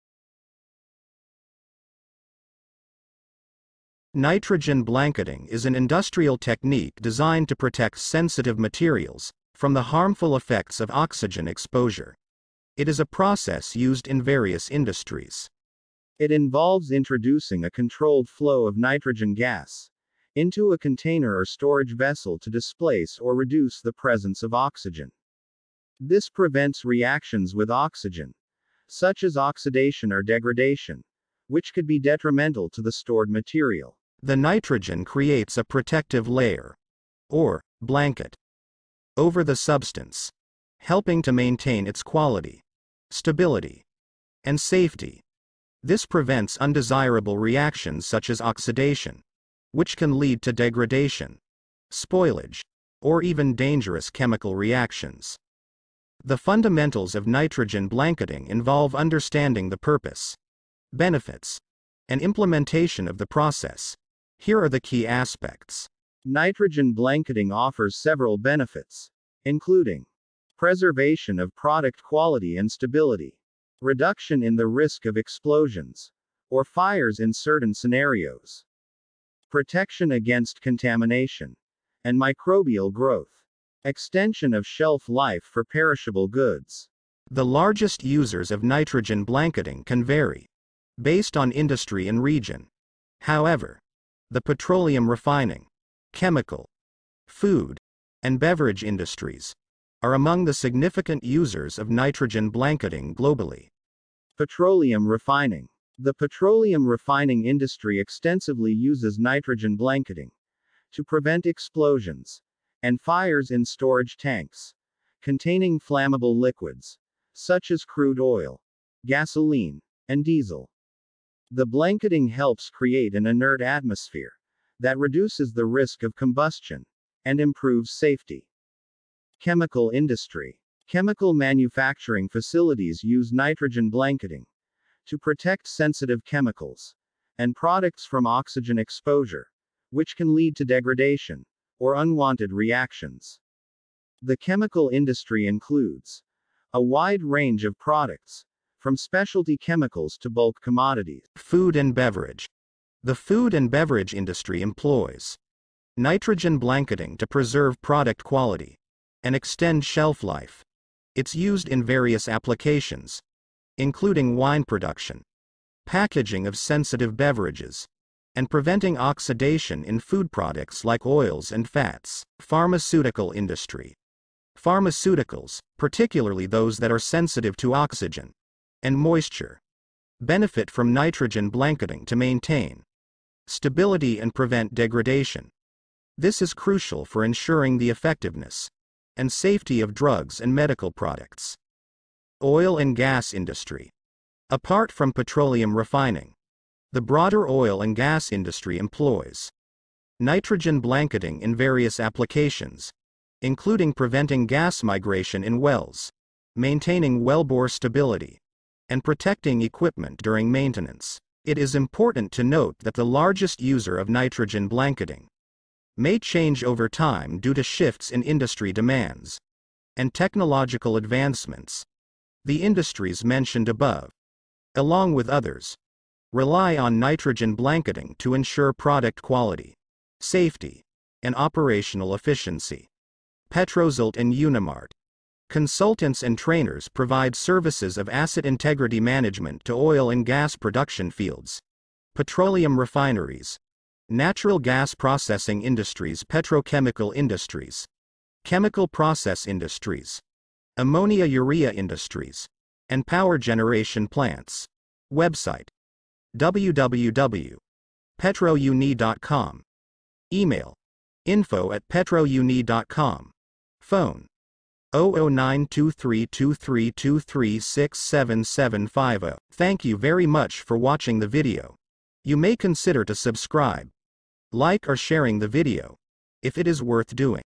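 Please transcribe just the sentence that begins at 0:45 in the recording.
This prevents undesirable reactions such as oxidation, which can lead to degradation, spoilage, or even dangerous chemical reactions.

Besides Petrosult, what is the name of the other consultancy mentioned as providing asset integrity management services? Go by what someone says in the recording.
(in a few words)
Unimart.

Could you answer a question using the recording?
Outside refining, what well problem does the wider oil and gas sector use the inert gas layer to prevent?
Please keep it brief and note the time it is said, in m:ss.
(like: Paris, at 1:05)
Gas migration, at 3:24.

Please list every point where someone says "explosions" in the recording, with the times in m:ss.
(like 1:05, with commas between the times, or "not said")
1:15, 1:51.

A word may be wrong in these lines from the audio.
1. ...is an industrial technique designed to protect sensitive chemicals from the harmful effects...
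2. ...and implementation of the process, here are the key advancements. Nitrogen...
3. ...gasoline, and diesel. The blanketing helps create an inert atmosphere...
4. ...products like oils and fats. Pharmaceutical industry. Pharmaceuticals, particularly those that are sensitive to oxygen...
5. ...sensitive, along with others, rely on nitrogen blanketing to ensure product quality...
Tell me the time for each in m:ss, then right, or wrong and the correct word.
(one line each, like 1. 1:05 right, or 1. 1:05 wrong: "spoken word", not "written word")
1. 0:05 wrong: "materials", not "chemicals"
2. 1:02 wrong: "aspects", not "advancements"
3. 1:59 right
4. 2:50 right
5. 3:43 wrong: "above", not "sensitive".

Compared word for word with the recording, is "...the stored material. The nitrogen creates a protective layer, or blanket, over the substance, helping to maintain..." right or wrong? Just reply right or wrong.
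right.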